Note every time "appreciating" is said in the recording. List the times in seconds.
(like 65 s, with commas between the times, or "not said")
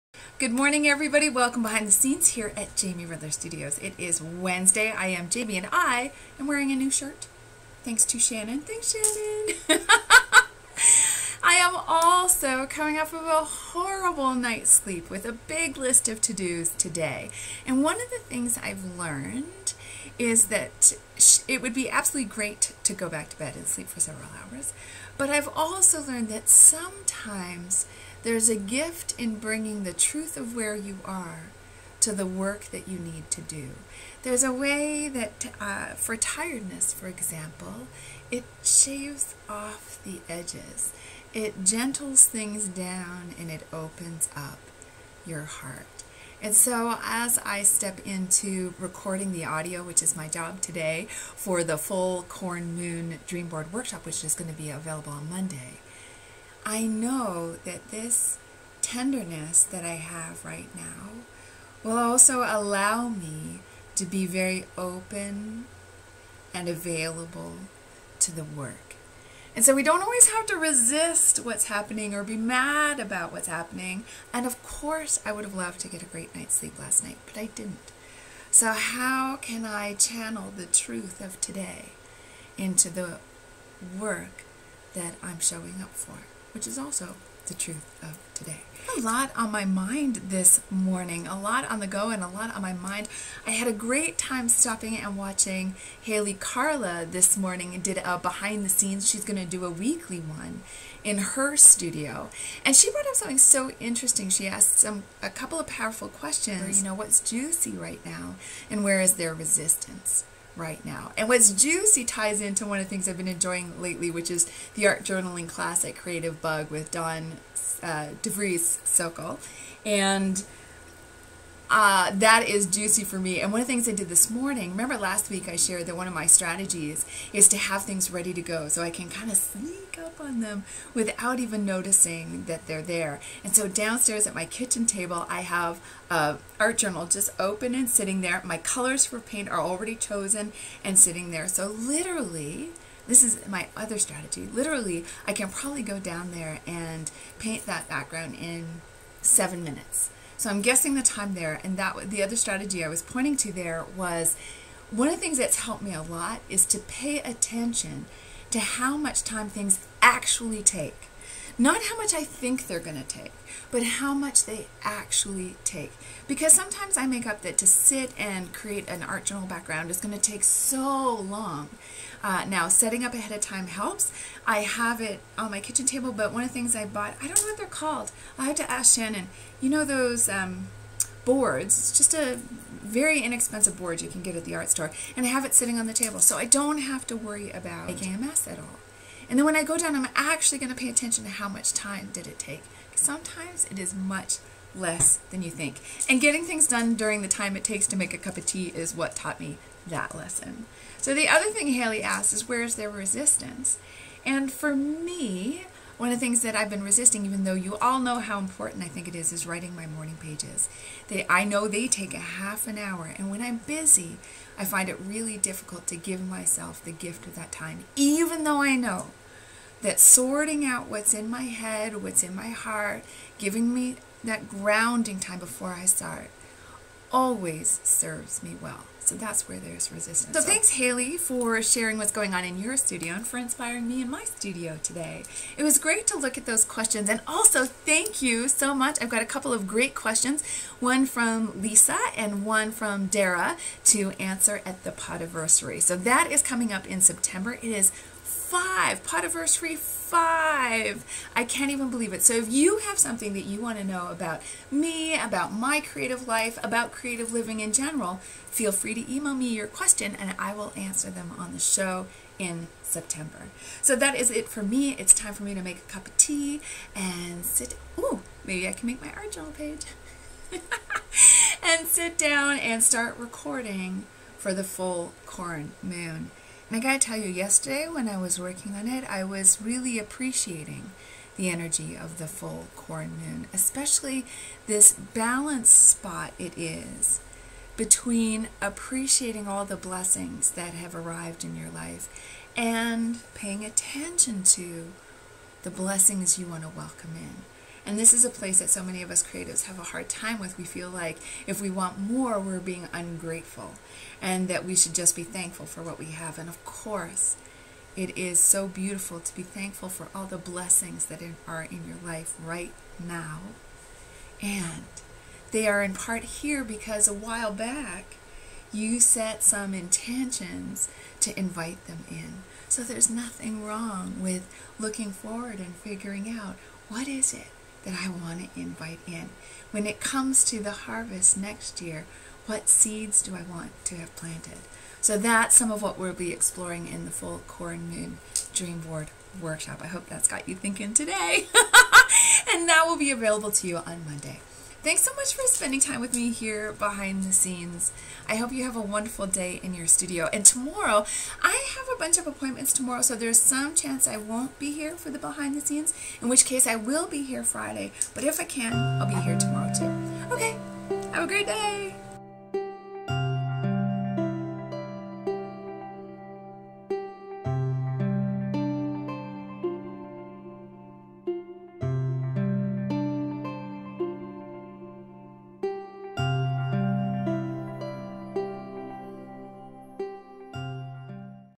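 279 s, 288 s.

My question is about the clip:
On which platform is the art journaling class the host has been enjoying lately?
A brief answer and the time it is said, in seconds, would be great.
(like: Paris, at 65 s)
Creative Bug, at 115 s.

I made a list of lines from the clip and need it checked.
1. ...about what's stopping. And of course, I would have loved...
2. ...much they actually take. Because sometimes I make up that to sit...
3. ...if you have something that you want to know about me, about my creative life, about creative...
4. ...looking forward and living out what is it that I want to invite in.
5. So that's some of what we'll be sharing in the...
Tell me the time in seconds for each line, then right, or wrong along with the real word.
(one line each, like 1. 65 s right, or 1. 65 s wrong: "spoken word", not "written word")
1. 72 s wrong: "happening", not "stopping"
2. 164 s right
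3. 252 s right
4. 324 s wrong: "figuring", not "living"
5. 334 s wrong: "exploring", not "sharing".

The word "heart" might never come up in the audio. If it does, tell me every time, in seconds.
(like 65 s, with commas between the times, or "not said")
45 s, 222 s.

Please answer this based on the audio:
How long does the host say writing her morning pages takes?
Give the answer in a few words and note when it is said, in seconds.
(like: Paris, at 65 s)
Half an hour, at 212 s.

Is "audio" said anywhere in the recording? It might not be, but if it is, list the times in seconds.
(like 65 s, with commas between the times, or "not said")
49 s.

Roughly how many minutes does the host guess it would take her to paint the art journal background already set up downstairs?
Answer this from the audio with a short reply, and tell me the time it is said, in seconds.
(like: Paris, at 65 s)
7, at 149 s.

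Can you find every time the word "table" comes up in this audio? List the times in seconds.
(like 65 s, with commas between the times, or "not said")
134 s, 175 s, 185 s.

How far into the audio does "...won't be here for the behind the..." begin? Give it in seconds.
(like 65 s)
354 s.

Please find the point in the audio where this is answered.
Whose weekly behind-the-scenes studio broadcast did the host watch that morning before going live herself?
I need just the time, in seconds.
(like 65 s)
96 s.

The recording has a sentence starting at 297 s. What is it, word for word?
And this is a place that so many of us creatives have a hard time with.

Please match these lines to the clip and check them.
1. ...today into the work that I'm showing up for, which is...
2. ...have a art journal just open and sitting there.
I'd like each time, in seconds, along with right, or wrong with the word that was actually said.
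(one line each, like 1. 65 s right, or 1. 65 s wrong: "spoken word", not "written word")
1. 81 s right
2. 135 s right.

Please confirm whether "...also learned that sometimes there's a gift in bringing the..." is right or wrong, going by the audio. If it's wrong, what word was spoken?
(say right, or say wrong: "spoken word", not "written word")
right.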